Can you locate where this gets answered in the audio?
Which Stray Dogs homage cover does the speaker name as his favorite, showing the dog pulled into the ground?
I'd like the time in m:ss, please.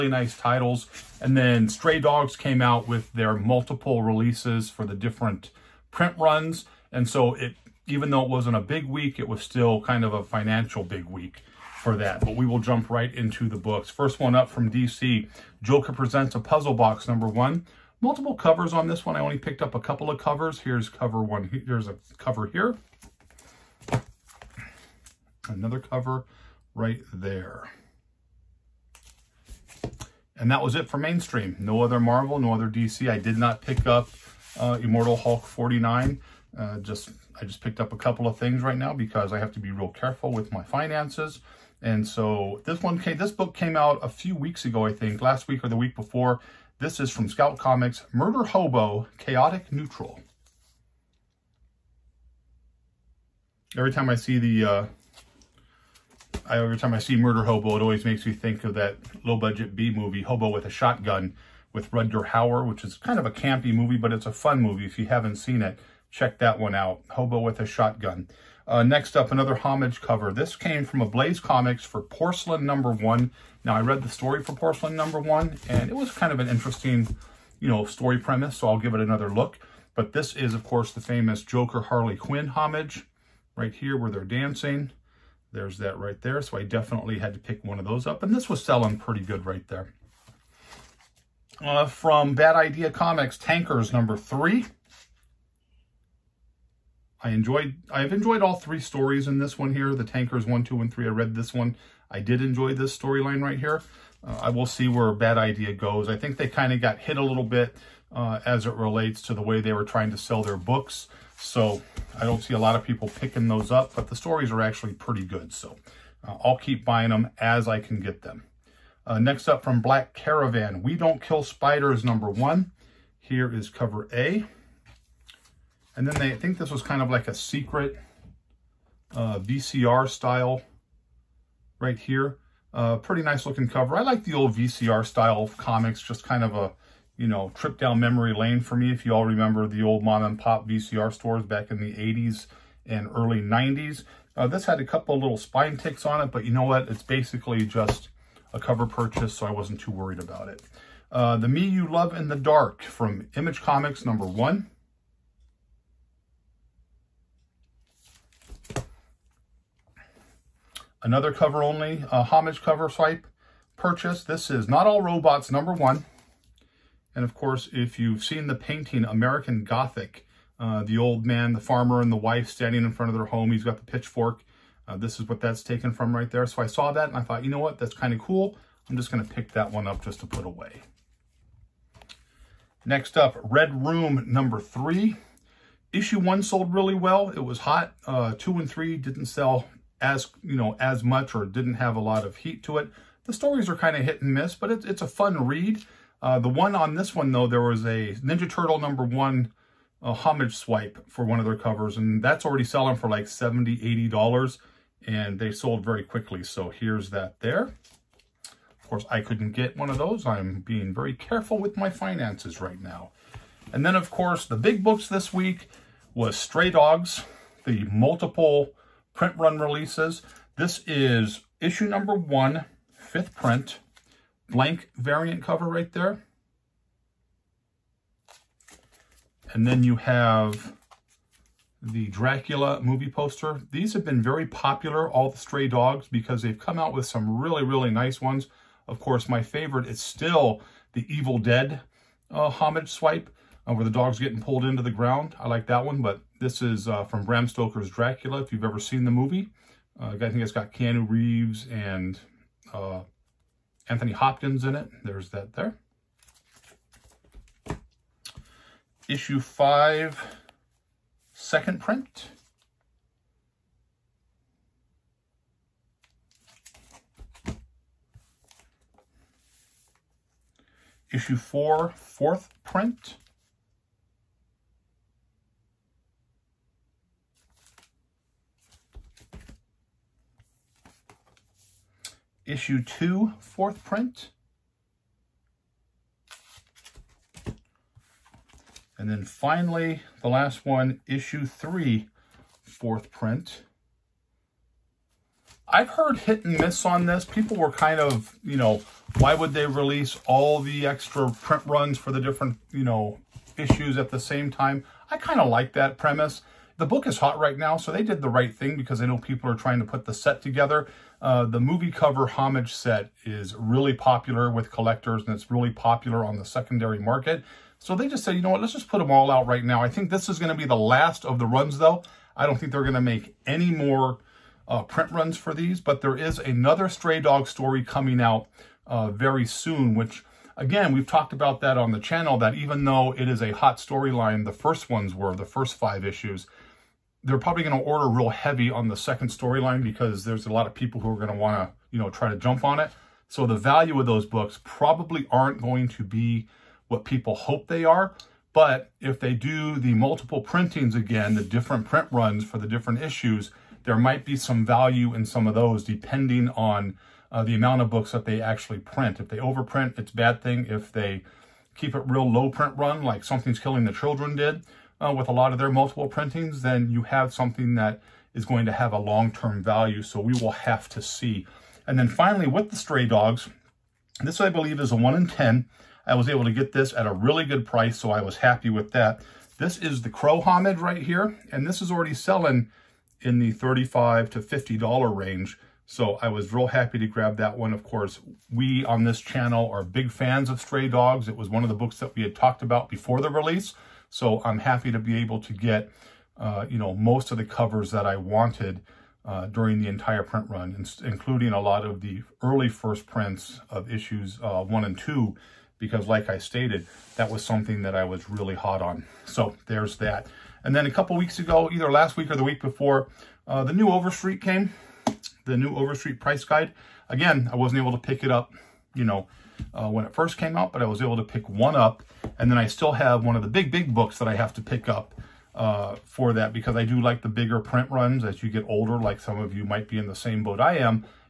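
4:01.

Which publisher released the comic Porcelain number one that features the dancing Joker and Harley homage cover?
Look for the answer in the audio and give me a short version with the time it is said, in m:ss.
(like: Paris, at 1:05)
Blaze Comics, at 1:11.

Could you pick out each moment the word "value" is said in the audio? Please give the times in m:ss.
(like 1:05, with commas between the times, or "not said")
5:43, 5:54, 6:09.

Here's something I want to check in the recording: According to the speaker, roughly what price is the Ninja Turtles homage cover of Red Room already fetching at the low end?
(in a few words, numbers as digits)
$70.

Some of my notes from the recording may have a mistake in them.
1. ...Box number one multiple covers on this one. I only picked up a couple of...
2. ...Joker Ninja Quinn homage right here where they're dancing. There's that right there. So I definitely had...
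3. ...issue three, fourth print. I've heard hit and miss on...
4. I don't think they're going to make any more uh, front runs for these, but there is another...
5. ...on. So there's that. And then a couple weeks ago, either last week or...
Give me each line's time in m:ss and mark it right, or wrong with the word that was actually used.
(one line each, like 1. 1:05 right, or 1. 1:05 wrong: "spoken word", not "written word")
1. 0:16 right
2. 1:21 wrong: "Harley", not "Ninja"
3. 4:51 right
4. 5:22 wrong: "print", not "front"
5. 6:48 right.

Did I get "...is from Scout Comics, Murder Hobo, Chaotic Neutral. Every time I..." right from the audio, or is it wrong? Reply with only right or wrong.
right.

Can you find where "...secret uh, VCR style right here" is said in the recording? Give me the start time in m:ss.
2:07.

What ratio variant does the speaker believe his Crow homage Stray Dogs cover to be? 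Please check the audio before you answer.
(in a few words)
1 in 10.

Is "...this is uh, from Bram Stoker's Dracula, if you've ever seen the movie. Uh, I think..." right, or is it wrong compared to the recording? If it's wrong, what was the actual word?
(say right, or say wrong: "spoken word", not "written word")
right.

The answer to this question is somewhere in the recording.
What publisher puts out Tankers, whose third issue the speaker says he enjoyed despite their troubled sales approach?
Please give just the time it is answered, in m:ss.
1:32.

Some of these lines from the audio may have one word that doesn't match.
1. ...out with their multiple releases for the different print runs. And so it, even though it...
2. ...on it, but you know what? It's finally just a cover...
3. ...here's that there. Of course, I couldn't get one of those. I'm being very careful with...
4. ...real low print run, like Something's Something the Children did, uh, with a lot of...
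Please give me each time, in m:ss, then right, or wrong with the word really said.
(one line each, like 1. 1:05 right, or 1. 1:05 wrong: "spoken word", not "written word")
1. 0:02 right
2. 2:26 wrong: "basically", not "finally"
3. 3:26 right
4. 6:02 wrong: "Killing", not "Something".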